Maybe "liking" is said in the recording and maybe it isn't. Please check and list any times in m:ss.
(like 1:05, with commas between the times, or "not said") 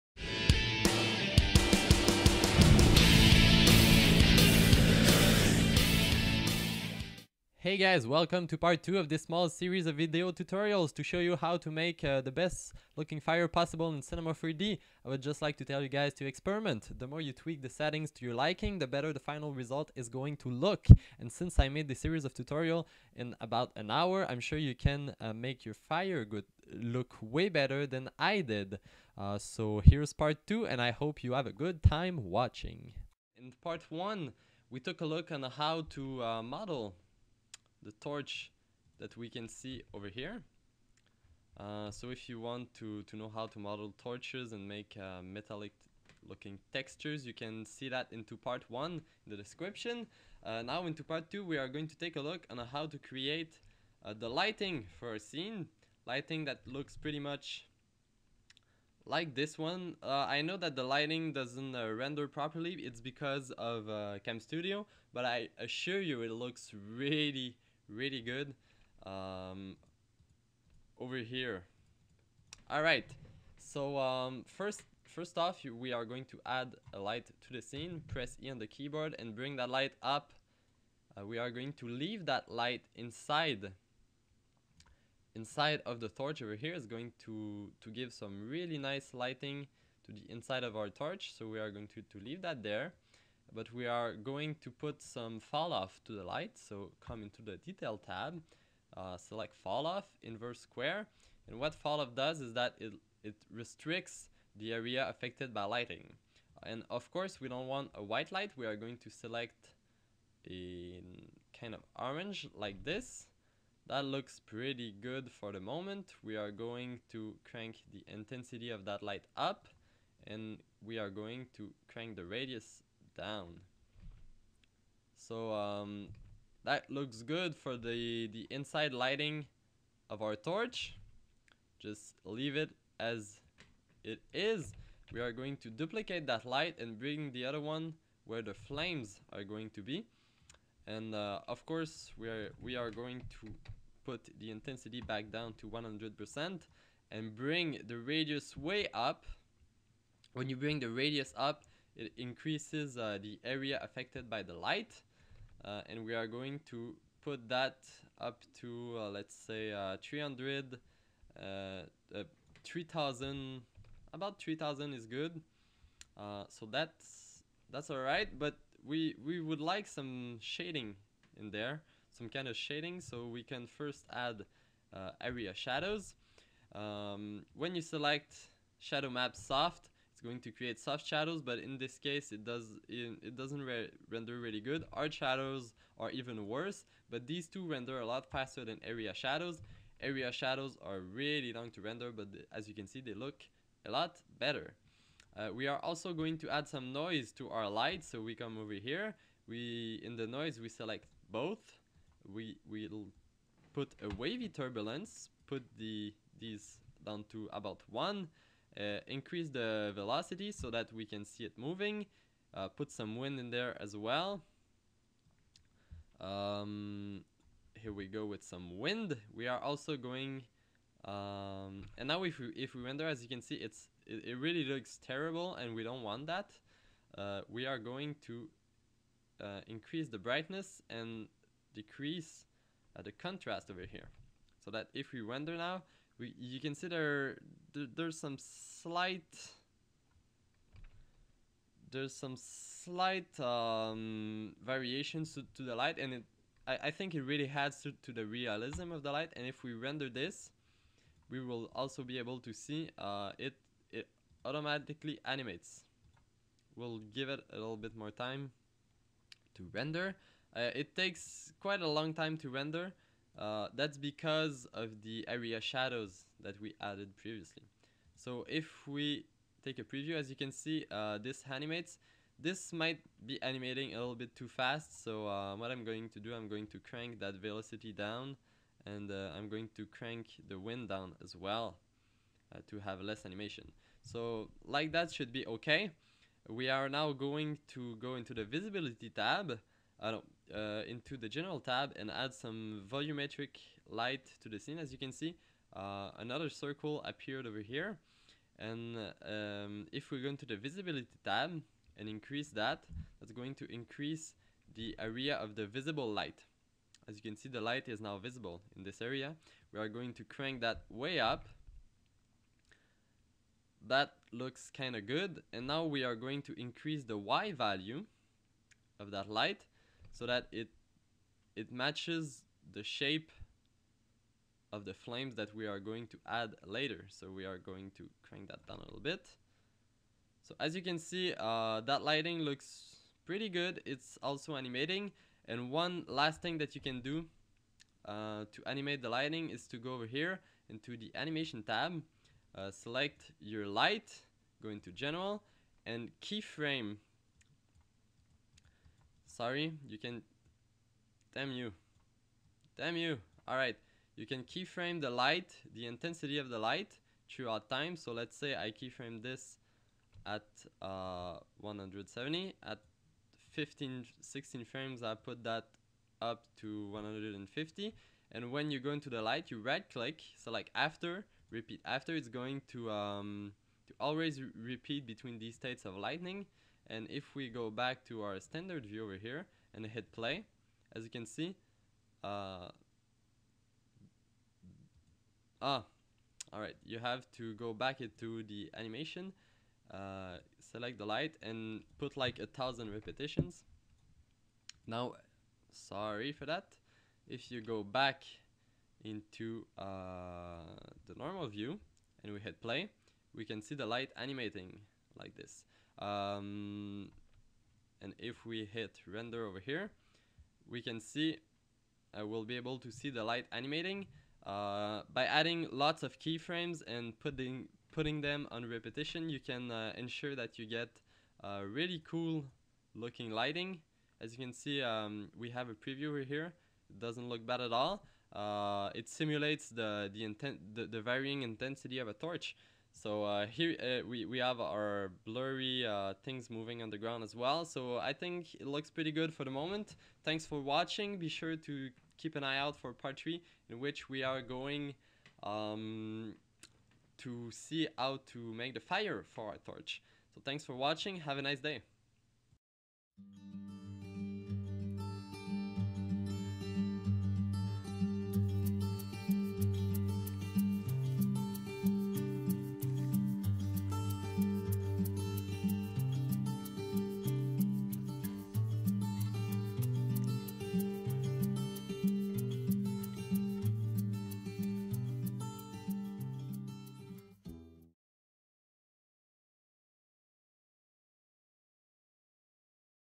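0:18.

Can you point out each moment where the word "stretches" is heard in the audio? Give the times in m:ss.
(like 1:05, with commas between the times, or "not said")
not said.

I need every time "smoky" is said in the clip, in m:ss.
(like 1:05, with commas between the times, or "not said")
not said.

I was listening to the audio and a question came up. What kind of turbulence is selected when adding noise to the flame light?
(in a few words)
Wavy turbulence.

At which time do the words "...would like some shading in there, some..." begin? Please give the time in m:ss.
2:49.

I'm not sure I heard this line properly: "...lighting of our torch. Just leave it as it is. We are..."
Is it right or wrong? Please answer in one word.
right.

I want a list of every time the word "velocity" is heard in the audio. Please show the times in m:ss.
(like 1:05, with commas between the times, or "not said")
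3:29, 4:37.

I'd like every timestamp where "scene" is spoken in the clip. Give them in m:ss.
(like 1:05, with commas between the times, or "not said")
0:55, 1:17, 4:54.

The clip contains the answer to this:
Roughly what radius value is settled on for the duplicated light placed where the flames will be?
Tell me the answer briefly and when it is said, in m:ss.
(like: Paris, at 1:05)
3000, at 2:44.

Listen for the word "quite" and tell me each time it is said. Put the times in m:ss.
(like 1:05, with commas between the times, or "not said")
4:21.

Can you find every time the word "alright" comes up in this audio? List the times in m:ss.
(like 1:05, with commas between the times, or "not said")
5:53, 6:26.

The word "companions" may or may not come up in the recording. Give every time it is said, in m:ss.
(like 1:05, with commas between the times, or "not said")
not said.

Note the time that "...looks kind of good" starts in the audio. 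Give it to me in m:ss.
5:14.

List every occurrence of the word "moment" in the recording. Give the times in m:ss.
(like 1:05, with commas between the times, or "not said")
1:55, 7:19.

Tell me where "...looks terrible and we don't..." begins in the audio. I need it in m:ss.
3:44.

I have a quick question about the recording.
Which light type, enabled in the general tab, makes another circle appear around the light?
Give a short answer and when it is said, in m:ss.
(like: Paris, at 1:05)
Volumetric light, at 4:52.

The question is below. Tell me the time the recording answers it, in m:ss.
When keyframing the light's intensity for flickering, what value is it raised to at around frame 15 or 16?
6:06.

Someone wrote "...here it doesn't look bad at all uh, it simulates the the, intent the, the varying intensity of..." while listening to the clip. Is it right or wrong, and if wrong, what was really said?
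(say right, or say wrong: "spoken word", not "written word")
right.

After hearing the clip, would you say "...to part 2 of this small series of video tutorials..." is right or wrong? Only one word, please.
right.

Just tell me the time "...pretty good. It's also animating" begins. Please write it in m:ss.
5:33.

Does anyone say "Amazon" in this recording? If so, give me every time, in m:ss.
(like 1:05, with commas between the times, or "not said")
not said.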